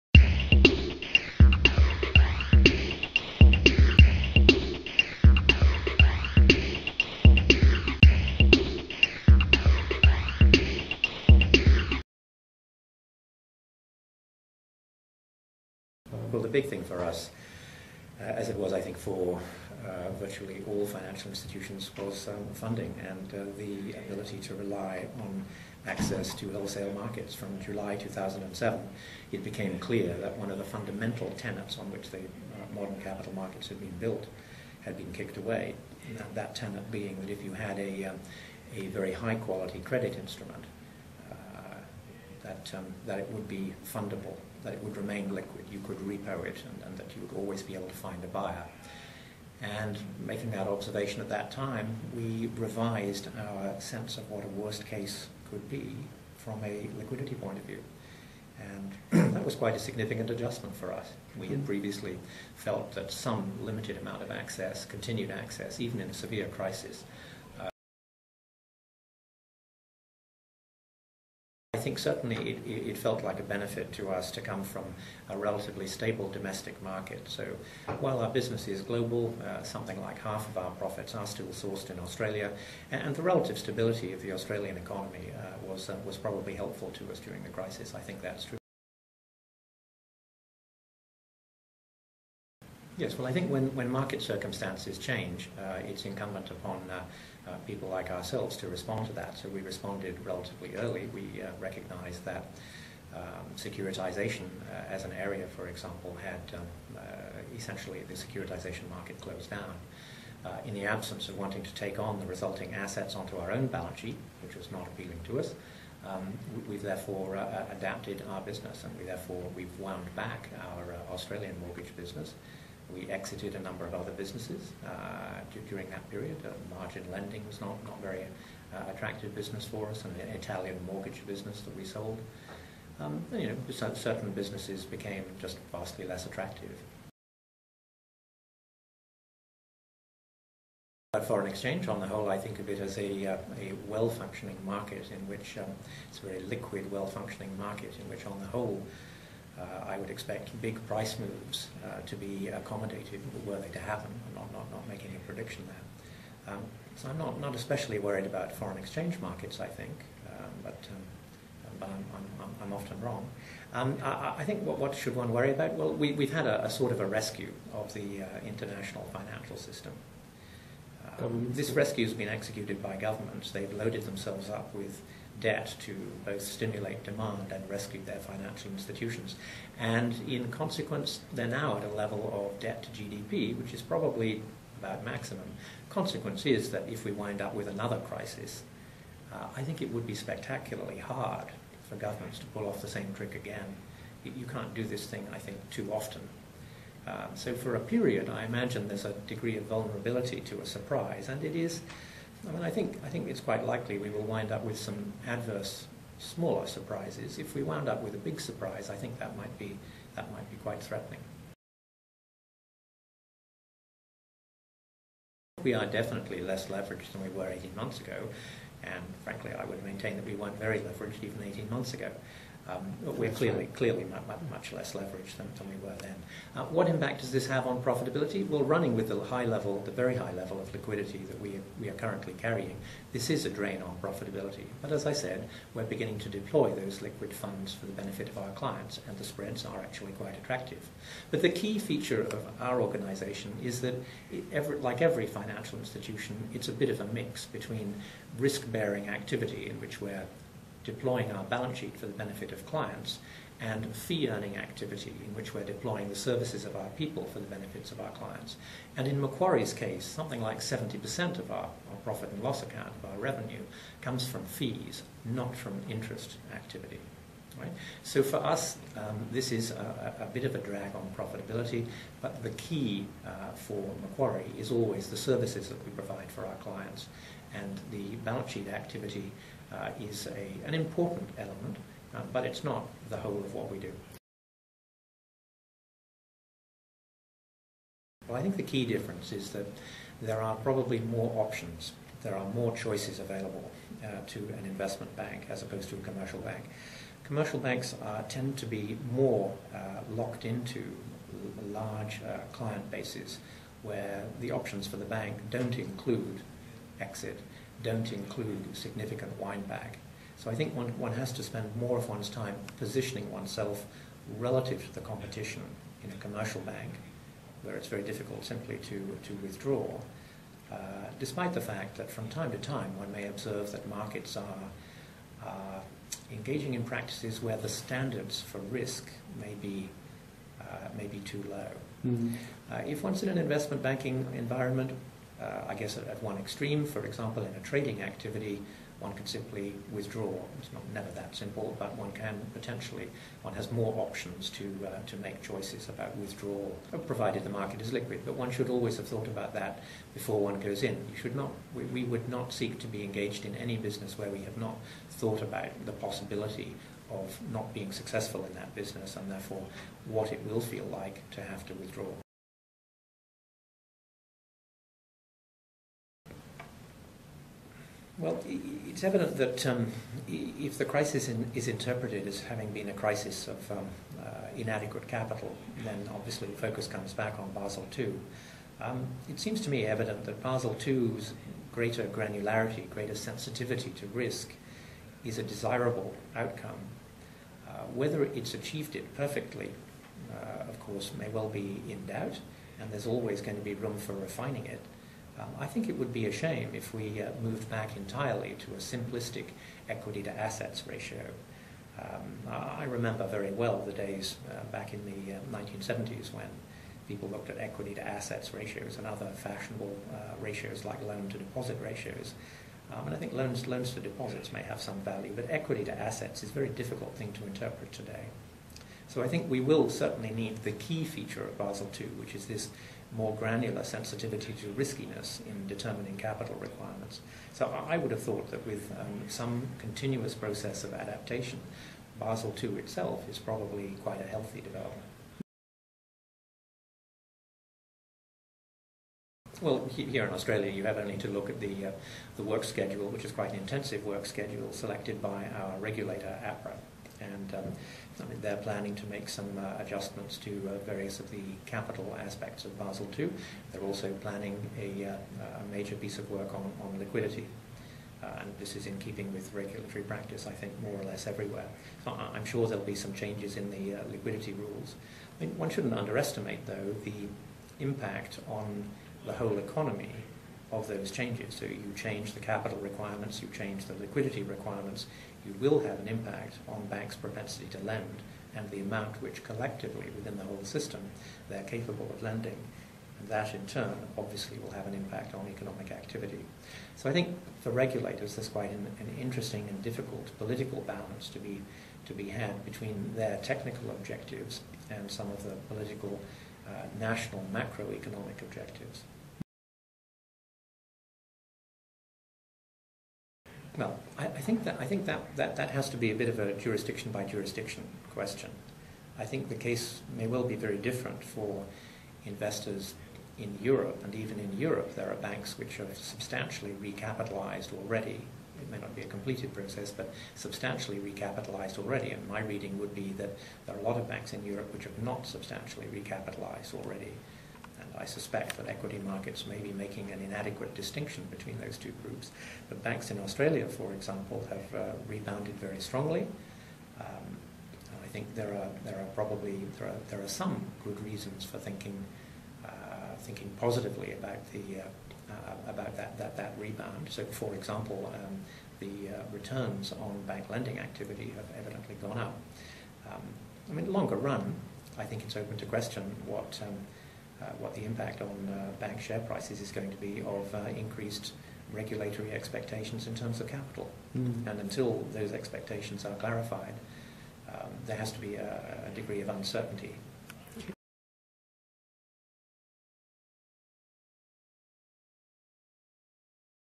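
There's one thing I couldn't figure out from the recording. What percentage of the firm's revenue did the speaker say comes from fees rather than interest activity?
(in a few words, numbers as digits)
70%.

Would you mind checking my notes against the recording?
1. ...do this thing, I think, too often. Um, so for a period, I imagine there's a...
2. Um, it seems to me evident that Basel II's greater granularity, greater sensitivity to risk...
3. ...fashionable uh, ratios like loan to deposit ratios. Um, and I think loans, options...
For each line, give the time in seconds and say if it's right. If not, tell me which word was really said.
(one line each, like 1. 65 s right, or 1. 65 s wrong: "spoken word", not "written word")
1. 194 s right
2. 378 s right
3. 409 s wrong: "loans", not "options".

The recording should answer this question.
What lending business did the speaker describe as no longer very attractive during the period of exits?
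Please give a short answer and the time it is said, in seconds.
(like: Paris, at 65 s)
margin lending, at 126 s.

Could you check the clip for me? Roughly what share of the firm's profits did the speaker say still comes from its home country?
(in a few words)
half.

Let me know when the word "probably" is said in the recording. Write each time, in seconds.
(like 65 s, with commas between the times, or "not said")
86 s, 183 s, 290 s, 433 s, 539 s.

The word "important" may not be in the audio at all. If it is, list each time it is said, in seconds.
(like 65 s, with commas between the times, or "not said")
280 s.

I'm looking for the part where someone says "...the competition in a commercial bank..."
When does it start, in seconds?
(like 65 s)
314 s.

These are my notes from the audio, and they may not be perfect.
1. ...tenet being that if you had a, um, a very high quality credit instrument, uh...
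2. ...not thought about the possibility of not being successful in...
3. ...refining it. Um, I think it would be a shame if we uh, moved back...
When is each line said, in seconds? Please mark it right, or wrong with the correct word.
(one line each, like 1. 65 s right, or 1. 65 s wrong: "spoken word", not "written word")
1. 36 s right
2. 354 s right
3. 394 s right.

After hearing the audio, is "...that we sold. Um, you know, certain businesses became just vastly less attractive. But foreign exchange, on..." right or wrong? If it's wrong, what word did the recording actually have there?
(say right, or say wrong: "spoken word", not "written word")
right.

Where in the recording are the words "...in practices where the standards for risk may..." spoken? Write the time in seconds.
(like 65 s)
326 s.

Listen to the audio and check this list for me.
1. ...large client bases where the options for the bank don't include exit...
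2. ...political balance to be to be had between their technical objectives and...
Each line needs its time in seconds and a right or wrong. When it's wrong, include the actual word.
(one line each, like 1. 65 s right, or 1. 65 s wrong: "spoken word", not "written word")
1. 301 s right
2. 490 s right.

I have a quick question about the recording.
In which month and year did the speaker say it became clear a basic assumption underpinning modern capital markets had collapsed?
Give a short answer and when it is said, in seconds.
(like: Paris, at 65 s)
July 2007, at 27 s.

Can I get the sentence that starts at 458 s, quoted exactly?
Uh, and this is in keeping with regulatory practice, I think, more or less everywhere.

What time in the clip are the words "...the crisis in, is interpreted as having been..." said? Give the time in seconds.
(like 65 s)
370 s.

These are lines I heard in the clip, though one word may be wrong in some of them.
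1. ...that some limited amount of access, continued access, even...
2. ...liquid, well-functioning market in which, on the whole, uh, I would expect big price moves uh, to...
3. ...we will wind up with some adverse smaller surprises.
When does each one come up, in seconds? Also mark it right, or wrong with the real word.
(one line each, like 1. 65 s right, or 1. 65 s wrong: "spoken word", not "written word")
1. 62 s right
2. 146 s right
3. 203 s right.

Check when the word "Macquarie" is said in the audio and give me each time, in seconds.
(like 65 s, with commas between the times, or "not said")
259 s, 274 s.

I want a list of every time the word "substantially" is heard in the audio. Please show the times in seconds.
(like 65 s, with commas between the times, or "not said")
515 s, 520 s, 525 s.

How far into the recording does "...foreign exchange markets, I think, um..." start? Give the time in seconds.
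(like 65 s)
158 s.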